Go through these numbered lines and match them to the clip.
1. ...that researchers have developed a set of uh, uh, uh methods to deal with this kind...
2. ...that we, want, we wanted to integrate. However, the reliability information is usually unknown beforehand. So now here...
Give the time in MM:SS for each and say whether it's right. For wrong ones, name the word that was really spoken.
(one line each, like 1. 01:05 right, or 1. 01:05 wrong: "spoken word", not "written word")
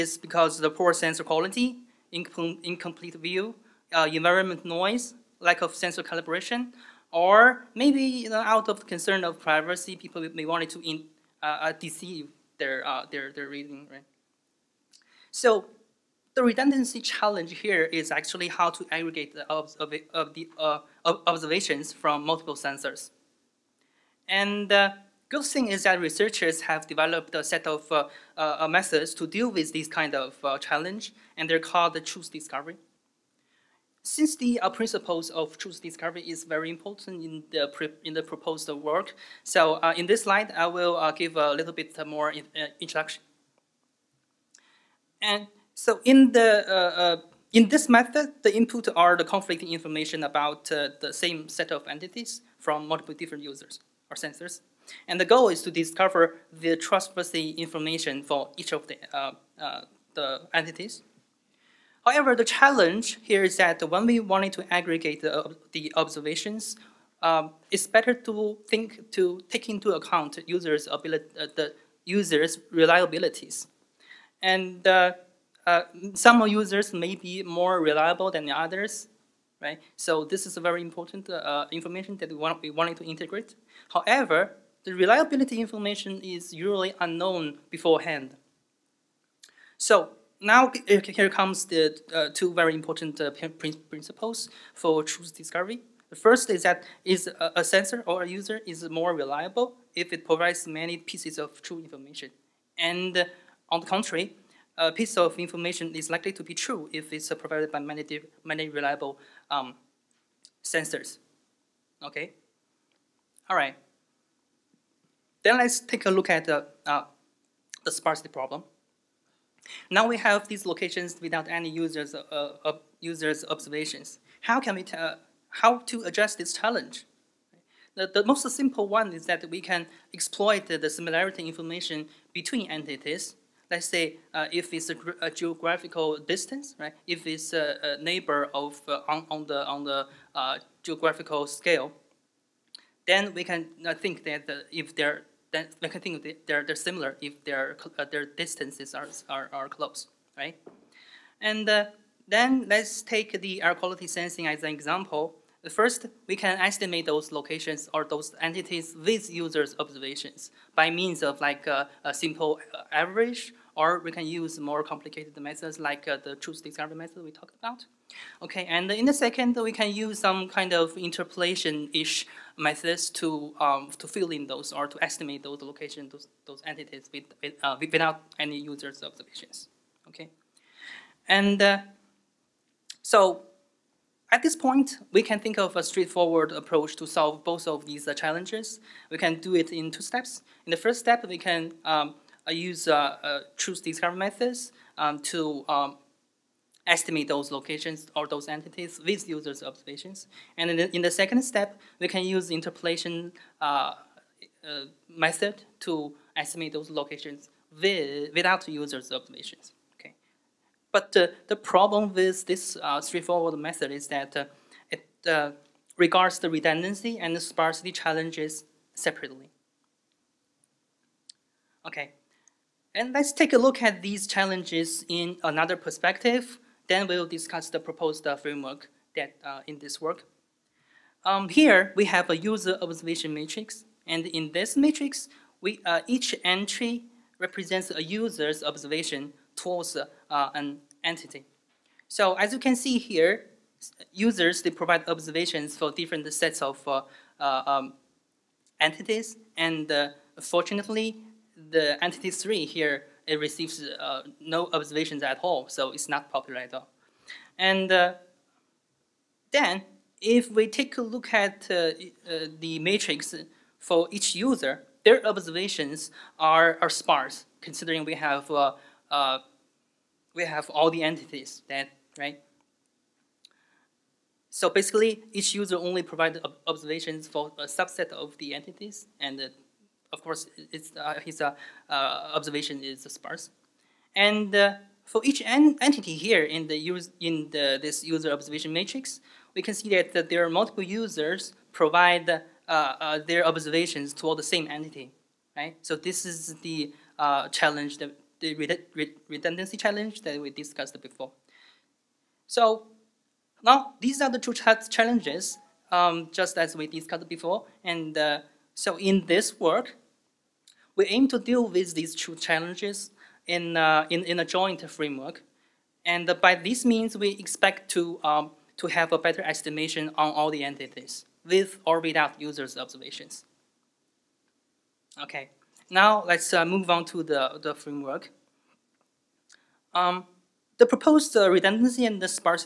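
1. 00:25 right
2. 01:22 right.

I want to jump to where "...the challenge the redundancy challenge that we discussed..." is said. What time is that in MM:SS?
04:56.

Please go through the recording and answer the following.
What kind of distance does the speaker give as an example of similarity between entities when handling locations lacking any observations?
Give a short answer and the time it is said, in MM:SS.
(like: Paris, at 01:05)
geographical distance, at 02:15.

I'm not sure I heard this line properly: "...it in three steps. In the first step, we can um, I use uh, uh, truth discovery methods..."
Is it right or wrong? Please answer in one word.
wrong.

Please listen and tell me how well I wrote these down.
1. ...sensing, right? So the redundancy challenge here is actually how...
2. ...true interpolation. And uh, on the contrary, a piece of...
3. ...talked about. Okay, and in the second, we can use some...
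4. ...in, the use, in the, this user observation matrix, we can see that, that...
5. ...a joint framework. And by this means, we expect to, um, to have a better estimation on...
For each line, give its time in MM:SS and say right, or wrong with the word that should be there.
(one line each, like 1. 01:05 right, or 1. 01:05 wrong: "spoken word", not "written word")
1. 00:13 wrong: "reading", not "sensing"
2. 01:41 wrong: "information", not "interpolation"
3. 02:47 right
4. 04:46 right
5. 05:14 right.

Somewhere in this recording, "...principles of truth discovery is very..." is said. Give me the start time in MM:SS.
00:34.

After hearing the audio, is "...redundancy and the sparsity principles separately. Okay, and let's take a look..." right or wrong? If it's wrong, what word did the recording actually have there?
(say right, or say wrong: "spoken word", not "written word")
wrong: "challenges", not "principles".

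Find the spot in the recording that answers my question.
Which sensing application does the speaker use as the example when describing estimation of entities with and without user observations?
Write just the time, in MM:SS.
02:33.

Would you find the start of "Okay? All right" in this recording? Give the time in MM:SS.
01:52.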